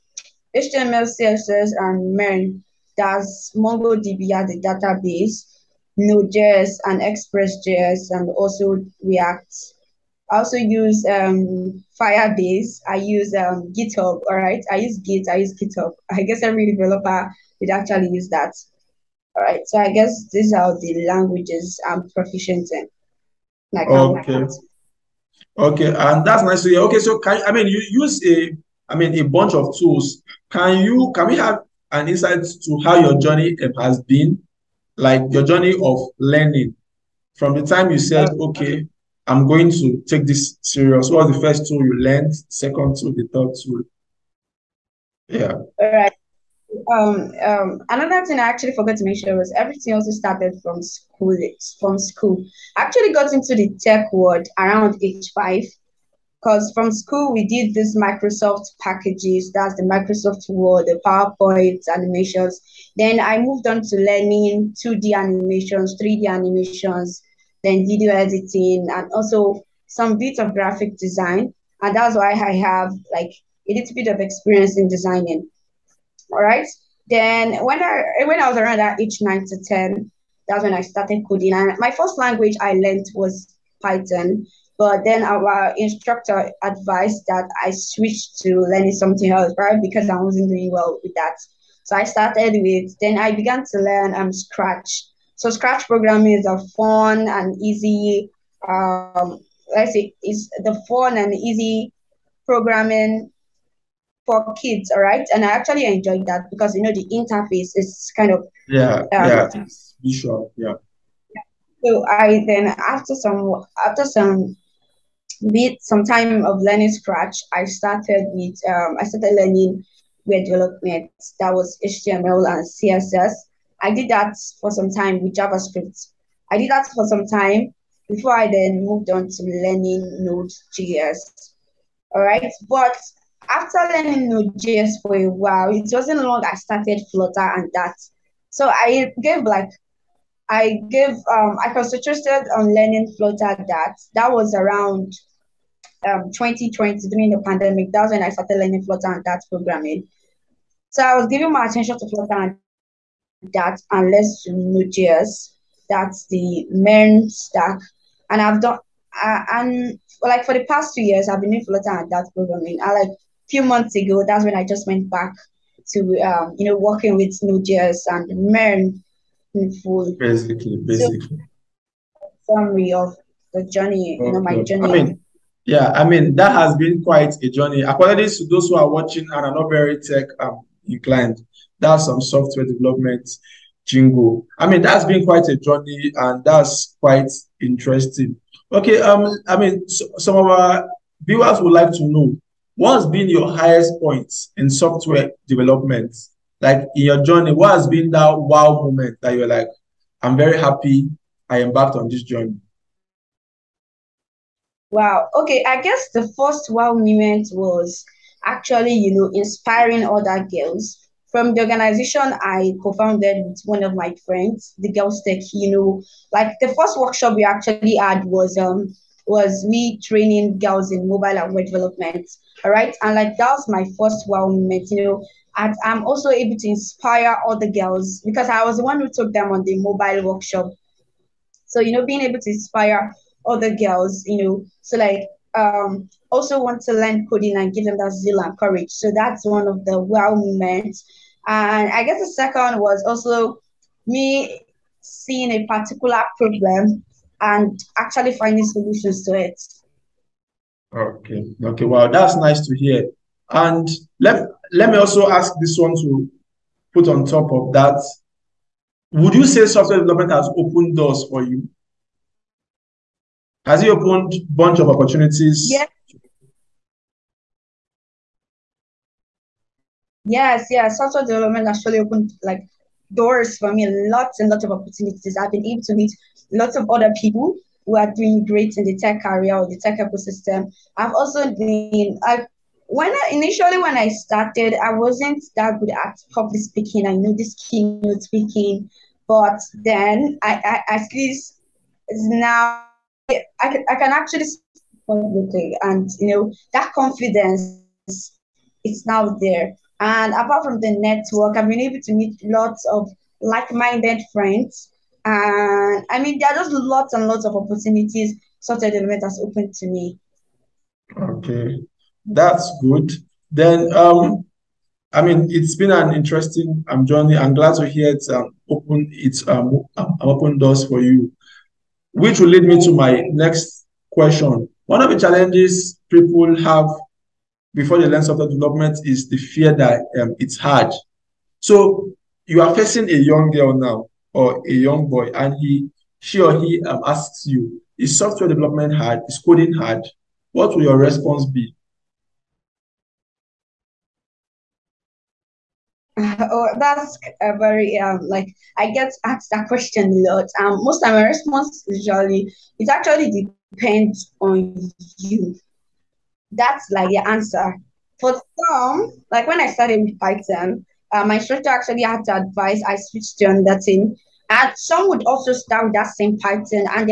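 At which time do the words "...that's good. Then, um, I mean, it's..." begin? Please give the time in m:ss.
5:12.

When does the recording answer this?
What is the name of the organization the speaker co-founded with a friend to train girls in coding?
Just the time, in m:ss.
3:34.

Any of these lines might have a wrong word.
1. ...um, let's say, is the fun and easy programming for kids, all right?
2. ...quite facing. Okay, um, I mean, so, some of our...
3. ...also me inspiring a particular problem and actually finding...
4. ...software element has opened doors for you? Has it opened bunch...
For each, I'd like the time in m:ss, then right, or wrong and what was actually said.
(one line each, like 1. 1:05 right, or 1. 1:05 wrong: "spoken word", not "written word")
1. 1:38 right
2. 3:06 wrong: "interesting", not "facing"
3. 4:03 wrong: "seeing", not "inspiring"
4. 4:19 wrong: "development", not "element".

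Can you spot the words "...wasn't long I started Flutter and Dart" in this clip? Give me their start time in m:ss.
2:15.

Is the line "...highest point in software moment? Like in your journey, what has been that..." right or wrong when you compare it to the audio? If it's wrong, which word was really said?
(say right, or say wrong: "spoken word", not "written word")
wrong: "development", not "moment".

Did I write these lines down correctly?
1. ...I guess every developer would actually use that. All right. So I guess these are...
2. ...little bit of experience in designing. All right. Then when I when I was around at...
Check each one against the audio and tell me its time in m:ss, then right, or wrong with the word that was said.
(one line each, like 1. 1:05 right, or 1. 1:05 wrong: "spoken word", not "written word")
1. 0:16 right
2. 1:13 right.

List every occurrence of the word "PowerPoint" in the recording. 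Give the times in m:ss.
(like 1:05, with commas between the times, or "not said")
1:01.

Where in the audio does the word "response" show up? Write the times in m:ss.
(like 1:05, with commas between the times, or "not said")
5:40, 5:51.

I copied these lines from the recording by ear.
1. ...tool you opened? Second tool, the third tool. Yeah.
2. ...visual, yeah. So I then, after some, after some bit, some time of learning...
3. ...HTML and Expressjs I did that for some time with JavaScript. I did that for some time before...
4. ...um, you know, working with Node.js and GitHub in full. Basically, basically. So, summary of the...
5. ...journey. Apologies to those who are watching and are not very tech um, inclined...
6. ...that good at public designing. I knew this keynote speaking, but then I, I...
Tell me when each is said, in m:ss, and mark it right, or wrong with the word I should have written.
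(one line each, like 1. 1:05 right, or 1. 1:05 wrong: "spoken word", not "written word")
1. 0:41 wrong: "learned", not "opened"
2. 1:50 right
3. 2:01 wrong: "CSS", not "Expressjs"
4. 2:46 wrong: "MERN", not "GitHub"
5. 2:57 right
6. 4:45 wrong: "speaking", not "designing".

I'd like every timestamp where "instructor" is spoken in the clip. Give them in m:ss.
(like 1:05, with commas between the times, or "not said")
1:25, 6:01.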